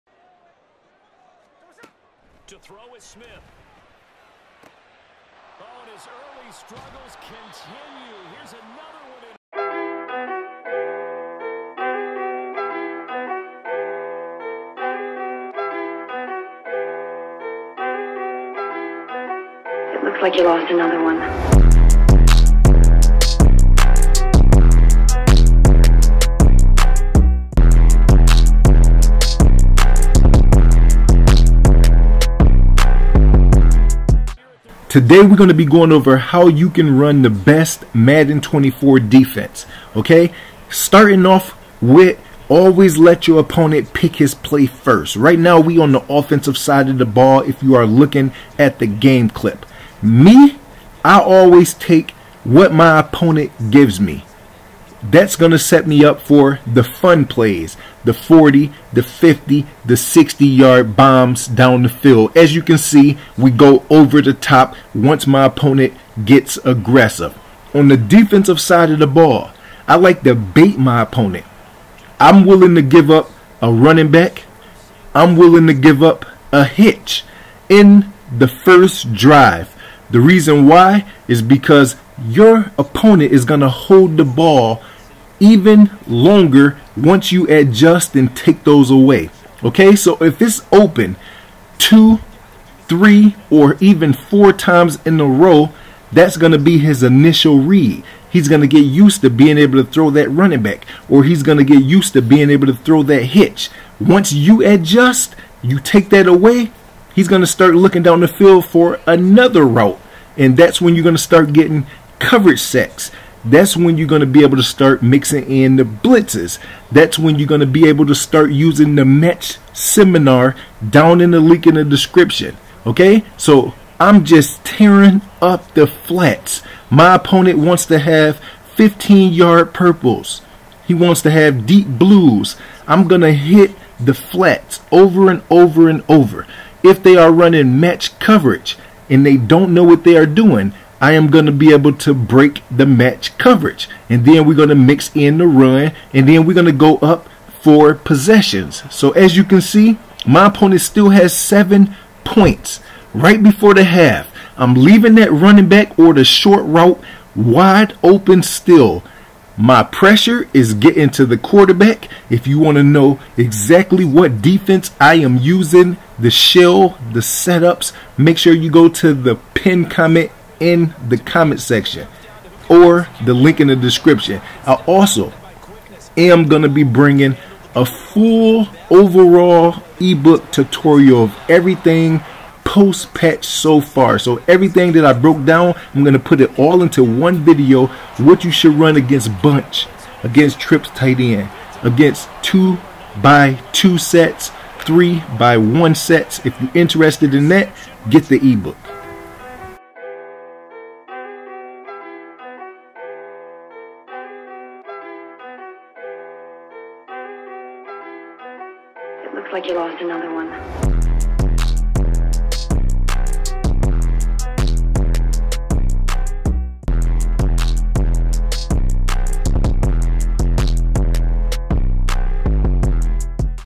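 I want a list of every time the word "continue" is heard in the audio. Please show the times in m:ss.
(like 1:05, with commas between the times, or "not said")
0:07.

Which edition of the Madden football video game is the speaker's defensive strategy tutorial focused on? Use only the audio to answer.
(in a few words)
Madden 24.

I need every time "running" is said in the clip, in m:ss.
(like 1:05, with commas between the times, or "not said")
1:13, 1:40, 2:17, 2:35.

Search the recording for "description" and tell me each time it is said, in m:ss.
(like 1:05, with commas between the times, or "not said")
2:01, 2:53.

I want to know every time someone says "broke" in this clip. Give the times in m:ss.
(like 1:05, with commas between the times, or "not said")
3:05.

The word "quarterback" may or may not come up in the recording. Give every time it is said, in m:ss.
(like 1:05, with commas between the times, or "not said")
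2:41.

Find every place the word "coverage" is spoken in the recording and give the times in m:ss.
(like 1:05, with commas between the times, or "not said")
1:52, 2:18, 2:23.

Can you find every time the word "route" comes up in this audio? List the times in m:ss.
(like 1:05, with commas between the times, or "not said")
1:49, 2:36.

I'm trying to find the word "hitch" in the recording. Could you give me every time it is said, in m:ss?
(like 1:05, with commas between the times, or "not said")
1:16, 1:43.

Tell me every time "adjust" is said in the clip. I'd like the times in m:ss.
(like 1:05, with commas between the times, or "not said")
1:27, 1:44.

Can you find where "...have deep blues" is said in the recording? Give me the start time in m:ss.
2:11.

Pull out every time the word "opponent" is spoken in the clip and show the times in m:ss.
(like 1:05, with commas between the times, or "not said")
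0:43, 0:52, 1:05, 1:11, 1:22, 2:07, 2:30.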